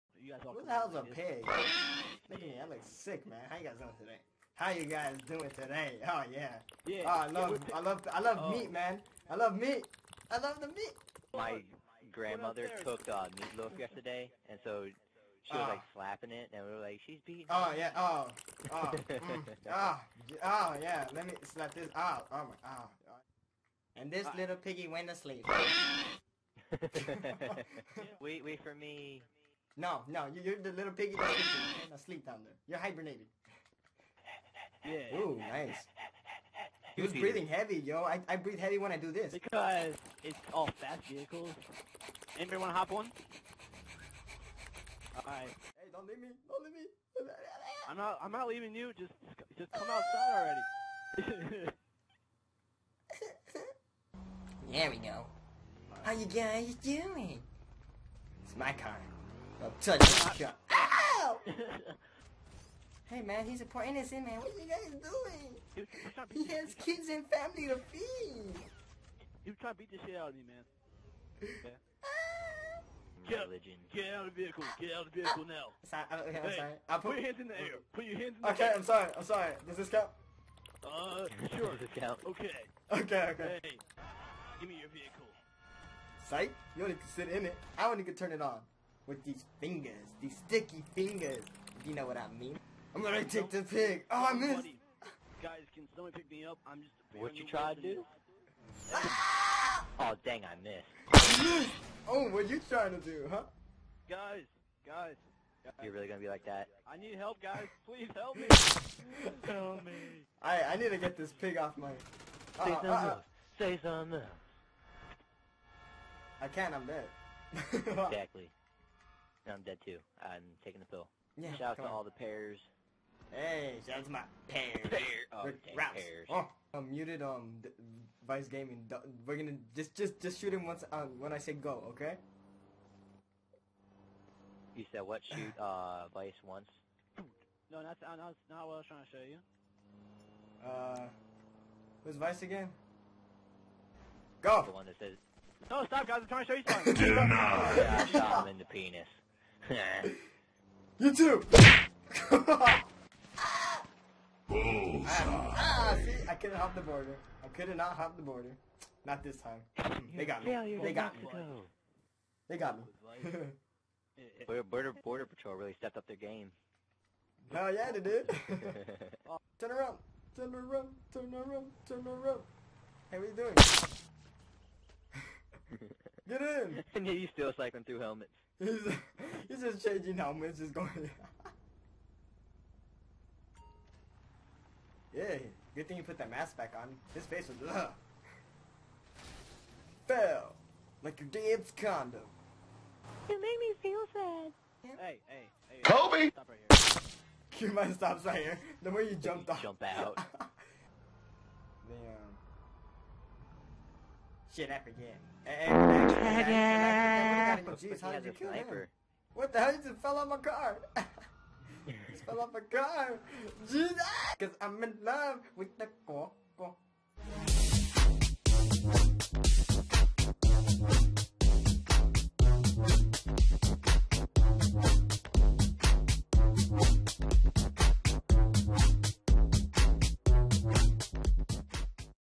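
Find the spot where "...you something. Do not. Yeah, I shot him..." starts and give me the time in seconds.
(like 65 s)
146 s.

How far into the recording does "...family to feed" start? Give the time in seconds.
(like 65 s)
67 s.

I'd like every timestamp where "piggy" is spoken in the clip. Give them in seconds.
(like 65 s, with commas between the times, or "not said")
24 s, 30 s.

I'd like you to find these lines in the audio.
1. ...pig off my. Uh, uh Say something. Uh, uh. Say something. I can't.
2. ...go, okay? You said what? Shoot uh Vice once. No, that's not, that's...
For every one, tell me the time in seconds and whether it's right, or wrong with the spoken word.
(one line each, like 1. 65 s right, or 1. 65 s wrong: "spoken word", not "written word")
1. 111 s right
2. 131 s right.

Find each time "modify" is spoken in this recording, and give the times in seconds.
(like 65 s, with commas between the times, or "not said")
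not said.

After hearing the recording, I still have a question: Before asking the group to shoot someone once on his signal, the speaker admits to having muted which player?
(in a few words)
Vice Gaming.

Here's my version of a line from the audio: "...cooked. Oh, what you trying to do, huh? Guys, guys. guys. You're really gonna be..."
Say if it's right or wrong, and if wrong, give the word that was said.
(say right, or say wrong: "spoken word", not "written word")
wrong: "missed", not "cooked".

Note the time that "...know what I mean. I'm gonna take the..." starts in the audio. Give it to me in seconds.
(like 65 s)
91 s.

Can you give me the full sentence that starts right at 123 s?
Hey, shout out to my pairs.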